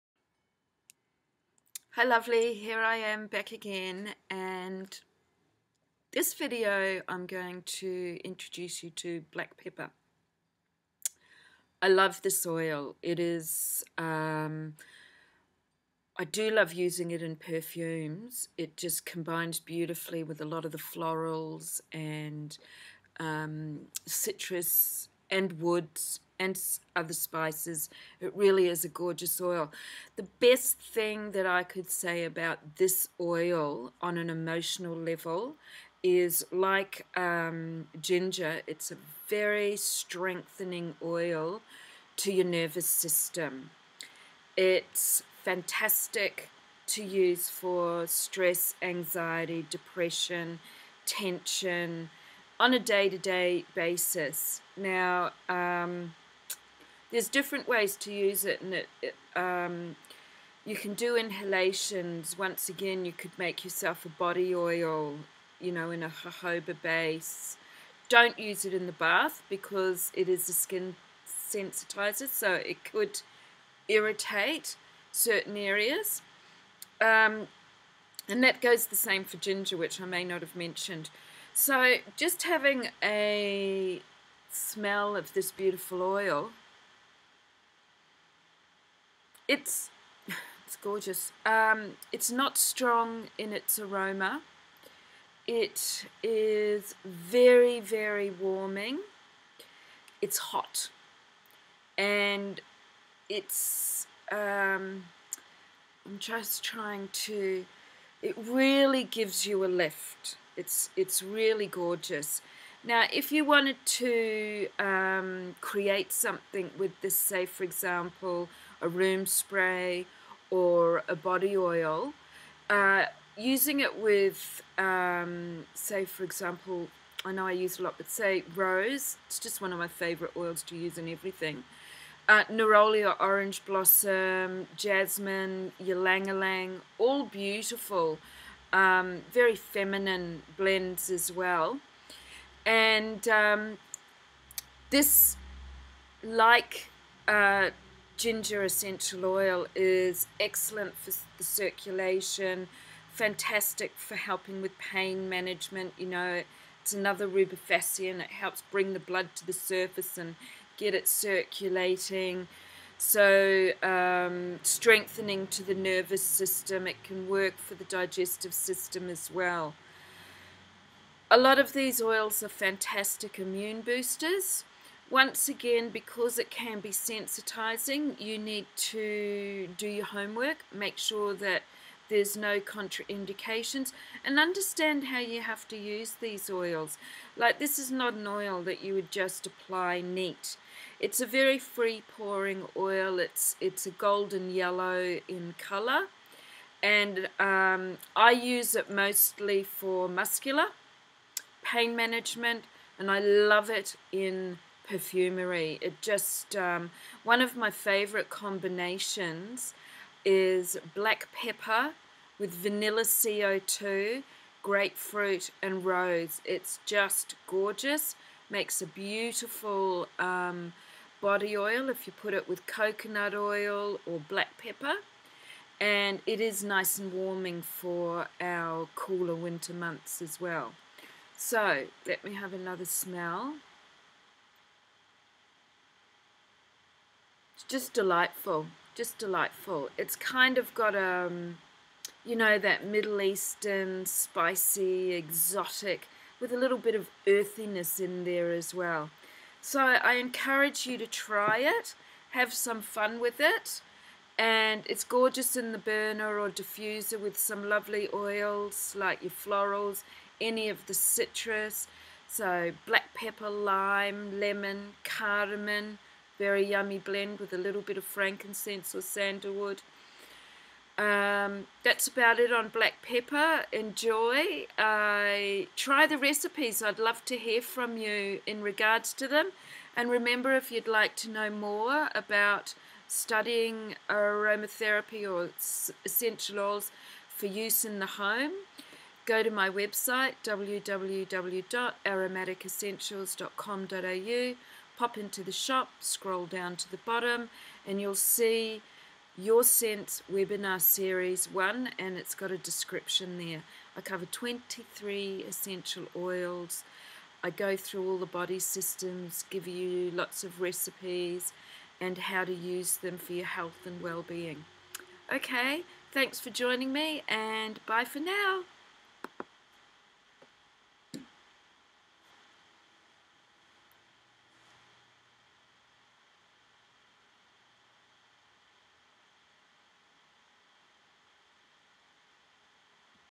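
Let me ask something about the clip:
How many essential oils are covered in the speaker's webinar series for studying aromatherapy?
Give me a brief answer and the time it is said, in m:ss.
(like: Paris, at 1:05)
23, at 5:04.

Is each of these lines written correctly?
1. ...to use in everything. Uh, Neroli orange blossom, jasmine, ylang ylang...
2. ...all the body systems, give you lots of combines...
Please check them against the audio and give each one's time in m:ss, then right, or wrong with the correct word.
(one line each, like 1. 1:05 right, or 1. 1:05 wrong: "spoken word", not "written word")
1. 2:10 right
2. 5:08 wrong: "recipes", not "combines".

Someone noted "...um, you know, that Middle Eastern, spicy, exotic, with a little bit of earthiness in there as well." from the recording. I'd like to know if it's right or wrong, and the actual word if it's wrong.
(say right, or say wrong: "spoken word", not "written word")
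right.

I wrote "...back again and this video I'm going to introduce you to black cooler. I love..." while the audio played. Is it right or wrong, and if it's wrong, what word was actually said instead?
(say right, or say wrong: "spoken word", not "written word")
wrong: "pepper", not "cooler".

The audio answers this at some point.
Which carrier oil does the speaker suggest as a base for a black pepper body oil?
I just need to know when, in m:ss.
1:06.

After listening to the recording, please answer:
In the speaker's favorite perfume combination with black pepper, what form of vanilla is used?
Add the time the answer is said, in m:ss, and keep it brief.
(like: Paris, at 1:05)
Vanilla CO2, at 3:32.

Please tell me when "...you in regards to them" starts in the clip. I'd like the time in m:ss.
4:37.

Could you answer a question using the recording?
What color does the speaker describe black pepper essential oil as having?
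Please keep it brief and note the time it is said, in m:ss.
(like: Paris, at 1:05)
Golden yellow, at 3:13.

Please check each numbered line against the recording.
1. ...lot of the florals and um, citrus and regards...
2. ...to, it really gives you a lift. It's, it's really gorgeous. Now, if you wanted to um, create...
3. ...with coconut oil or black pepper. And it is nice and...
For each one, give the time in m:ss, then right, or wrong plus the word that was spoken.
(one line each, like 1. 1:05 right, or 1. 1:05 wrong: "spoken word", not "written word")
1. 0:20 wrong: "woods", not "regards"
2. 1:47 right
3. 3:42 right.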